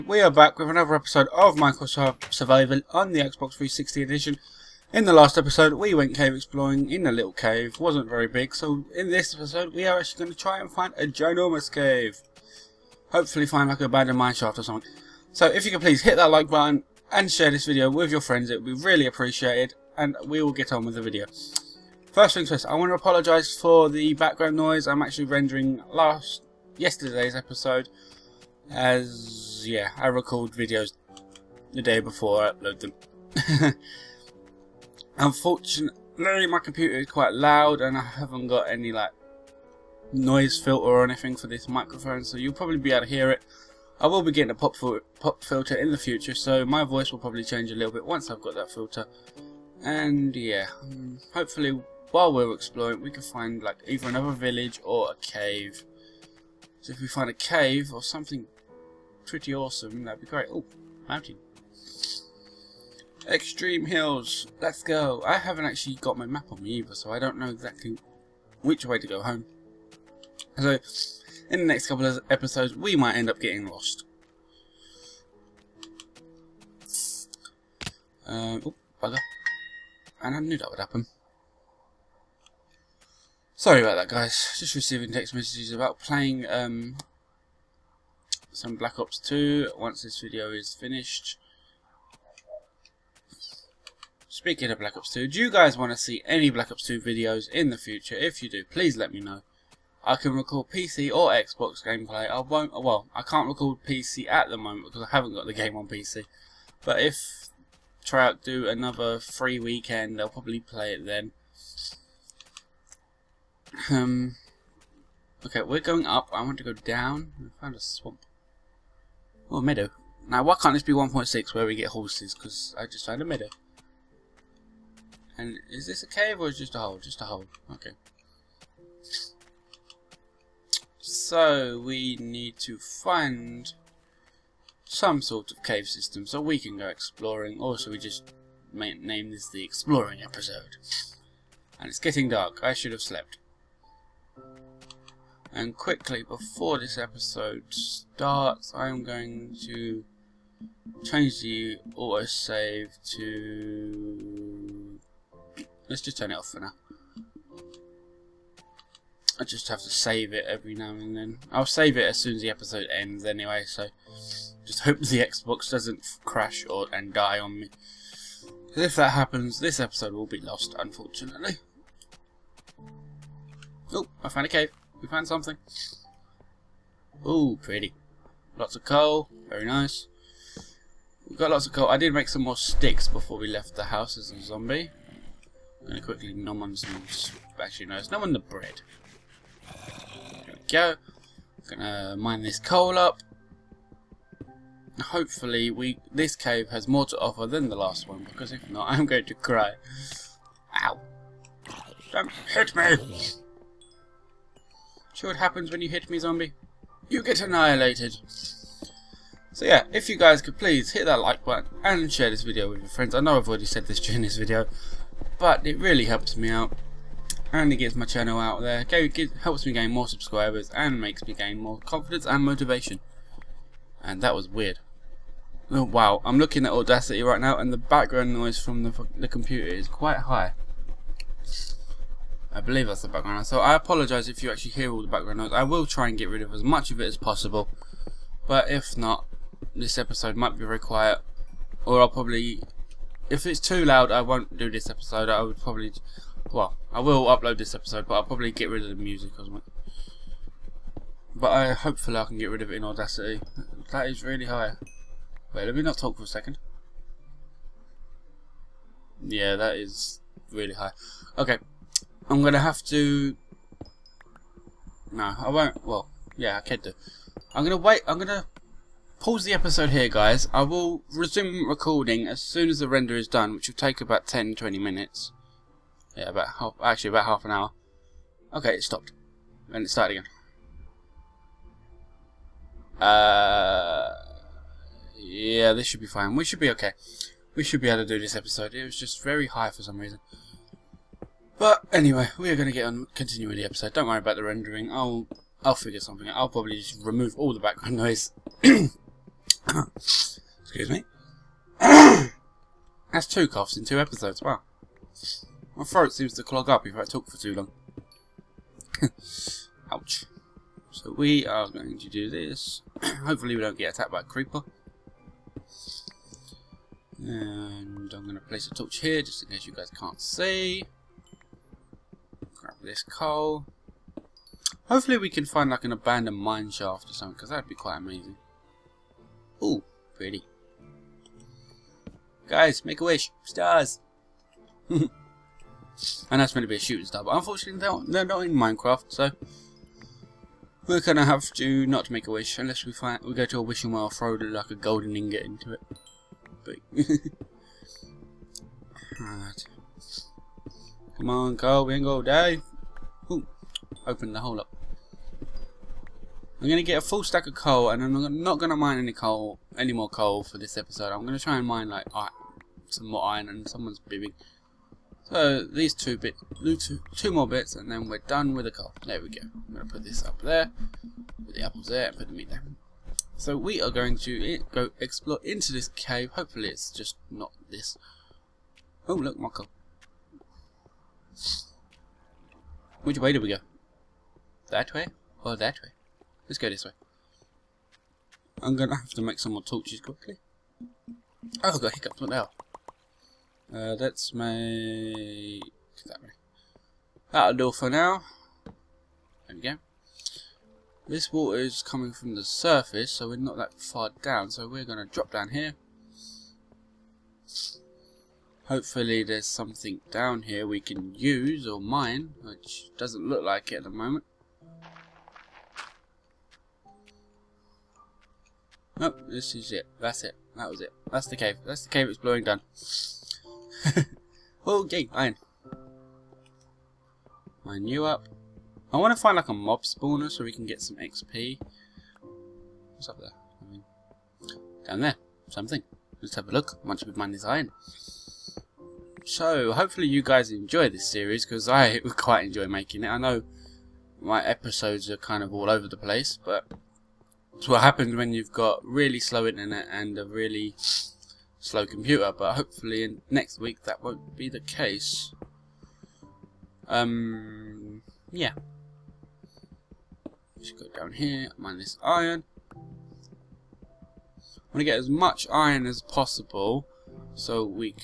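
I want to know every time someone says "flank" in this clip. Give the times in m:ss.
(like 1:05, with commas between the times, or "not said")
not said.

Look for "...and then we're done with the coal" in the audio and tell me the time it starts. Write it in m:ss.
6:07.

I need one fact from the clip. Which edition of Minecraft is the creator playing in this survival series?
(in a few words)
Xbox 360 edition.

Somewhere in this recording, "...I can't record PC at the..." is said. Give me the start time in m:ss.
1:43.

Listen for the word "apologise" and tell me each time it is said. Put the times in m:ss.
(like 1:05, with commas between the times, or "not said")
0:22, 3:53.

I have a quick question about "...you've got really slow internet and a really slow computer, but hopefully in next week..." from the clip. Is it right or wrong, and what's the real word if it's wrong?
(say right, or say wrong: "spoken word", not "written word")
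right.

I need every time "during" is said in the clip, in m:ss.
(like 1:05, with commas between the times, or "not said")
3:33.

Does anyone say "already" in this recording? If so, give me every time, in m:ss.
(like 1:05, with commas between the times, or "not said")
3:33.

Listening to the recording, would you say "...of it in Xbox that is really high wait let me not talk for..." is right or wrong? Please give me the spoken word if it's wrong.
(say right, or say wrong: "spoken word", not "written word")
wrong: "Audacity", not "Xbox".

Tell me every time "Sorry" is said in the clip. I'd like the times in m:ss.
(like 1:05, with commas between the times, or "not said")
1:23.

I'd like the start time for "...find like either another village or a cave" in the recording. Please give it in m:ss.
0:53.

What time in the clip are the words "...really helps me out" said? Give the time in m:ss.
3:35.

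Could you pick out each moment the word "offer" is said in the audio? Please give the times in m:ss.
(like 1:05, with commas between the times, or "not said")
3:17.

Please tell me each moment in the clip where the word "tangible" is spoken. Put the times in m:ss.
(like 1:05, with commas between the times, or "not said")
not said.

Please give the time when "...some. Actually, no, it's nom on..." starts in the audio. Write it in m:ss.
3:06.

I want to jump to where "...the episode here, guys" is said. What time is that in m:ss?
4:29.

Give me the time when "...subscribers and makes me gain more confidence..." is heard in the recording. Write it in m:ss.
3:40.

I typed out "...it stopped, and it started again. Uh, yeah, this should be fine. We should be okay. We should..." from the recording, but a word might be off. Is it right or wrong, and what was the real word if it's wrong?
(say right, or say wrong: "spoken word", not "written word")
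right.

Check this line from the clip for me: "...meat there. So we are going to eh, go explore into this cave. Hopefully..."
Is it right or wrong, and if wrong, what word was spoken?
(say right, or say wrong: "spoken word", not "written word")
right.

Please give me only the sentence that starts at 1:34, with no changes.
Speaking of Black Ops 2, do you guys want to see any Black Ops 2 videos in the future?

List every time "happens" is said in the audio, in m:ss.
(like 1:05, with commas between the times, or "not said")
1:20, 2:49, 3:25, 7:27.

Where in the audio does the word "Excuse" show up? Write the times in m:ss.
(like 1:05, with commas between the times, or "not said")
4:58.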